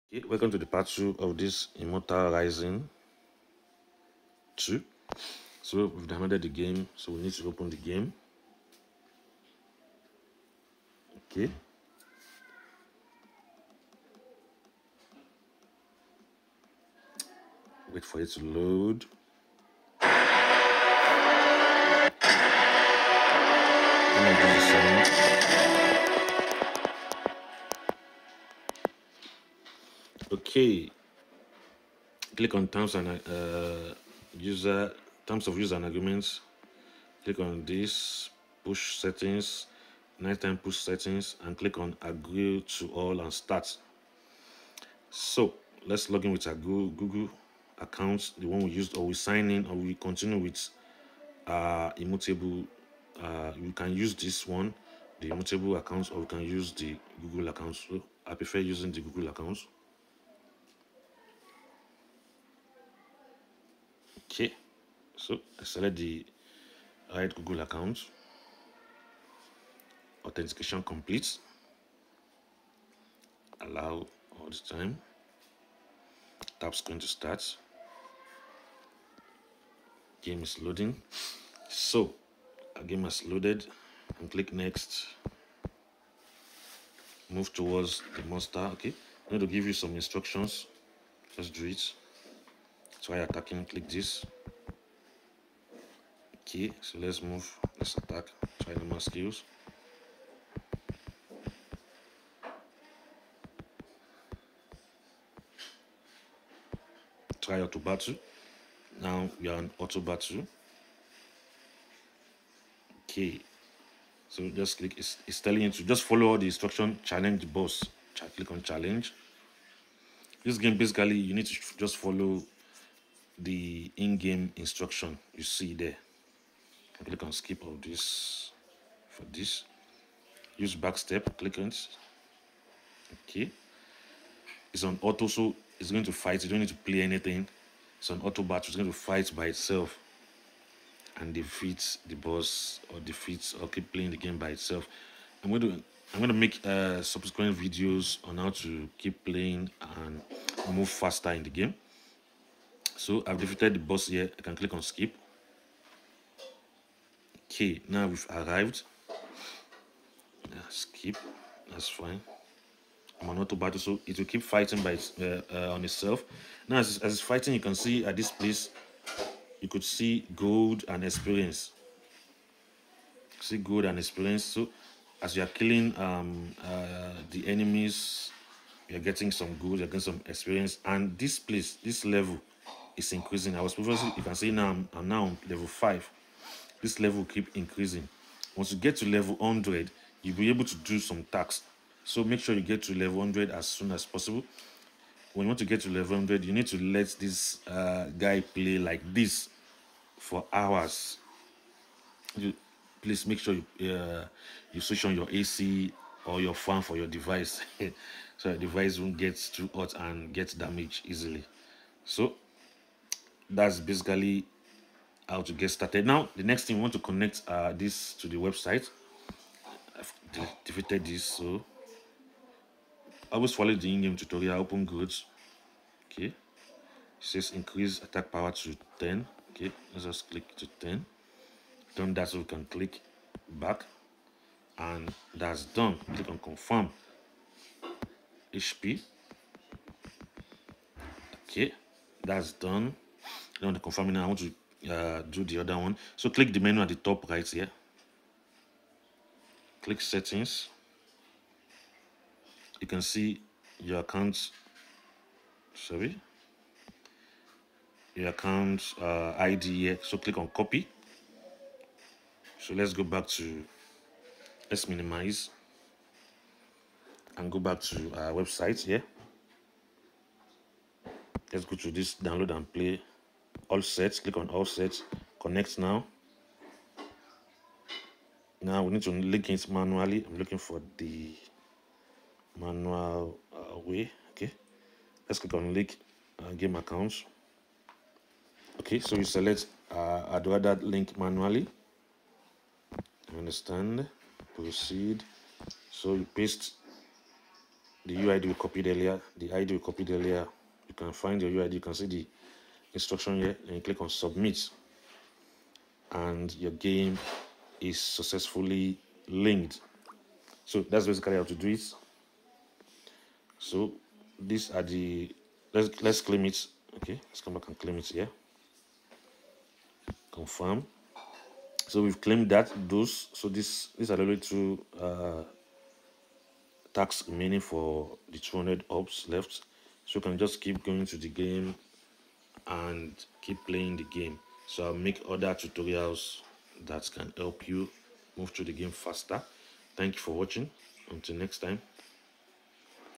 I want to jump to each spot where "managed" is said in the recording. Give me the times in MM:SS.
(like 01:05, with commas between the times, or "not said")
not said.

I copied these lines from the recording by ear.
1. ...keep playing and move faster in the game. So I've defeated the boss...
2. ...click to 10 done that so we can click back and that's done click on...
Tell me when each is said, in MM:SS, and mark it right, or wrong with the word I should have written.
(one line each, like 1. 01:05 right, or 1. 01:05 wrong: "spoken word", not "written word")
1. 02:28 right
2. 03:50 right.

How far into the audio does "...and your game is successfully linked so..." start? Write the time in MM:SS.
05:06.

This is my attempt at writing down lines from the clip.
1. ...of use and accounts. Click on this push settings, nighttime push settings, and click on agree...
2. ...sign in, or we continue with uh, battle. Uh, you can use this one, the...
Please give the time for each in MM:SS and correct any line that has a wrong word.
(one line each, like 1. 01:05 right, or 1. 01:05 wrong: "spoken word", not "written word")
1. 00:35 wrong: "agreements", not "accounts"
2. 00:49 wrong: "immutable", not "battle".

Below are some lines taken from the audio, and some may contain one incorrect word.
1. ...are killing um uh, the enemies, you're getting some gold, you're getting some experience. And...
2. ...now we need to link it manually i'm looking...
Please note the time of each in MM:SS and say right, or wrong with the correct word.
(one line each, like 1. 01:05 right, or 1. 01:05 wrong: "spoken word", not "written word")
1. 02:55 right
2. 04:38 right.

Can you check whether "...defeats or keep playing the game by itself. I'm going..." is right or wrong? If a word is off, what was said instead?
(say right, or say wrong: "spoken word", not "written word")
right.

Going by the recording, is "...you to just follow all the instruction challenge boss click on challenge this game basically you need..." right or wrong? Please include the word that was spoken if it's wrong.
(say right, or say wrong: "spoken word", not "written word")
right.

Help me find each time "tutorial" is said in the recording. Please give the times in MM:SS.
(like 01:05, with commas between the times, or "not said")
03:44, 05:35.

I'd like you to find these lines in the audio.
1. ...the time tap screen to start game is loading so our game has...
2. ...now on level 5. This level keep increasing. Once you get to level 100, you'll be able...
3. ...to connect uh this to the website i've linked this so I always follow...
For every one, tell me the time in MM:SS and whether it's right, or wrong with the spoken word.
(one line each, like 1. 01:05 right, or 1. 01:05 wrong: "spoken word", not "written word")
1. 01:14 right
2. 03:05 right
3. 03:36 wrong: "defeated", not "linked".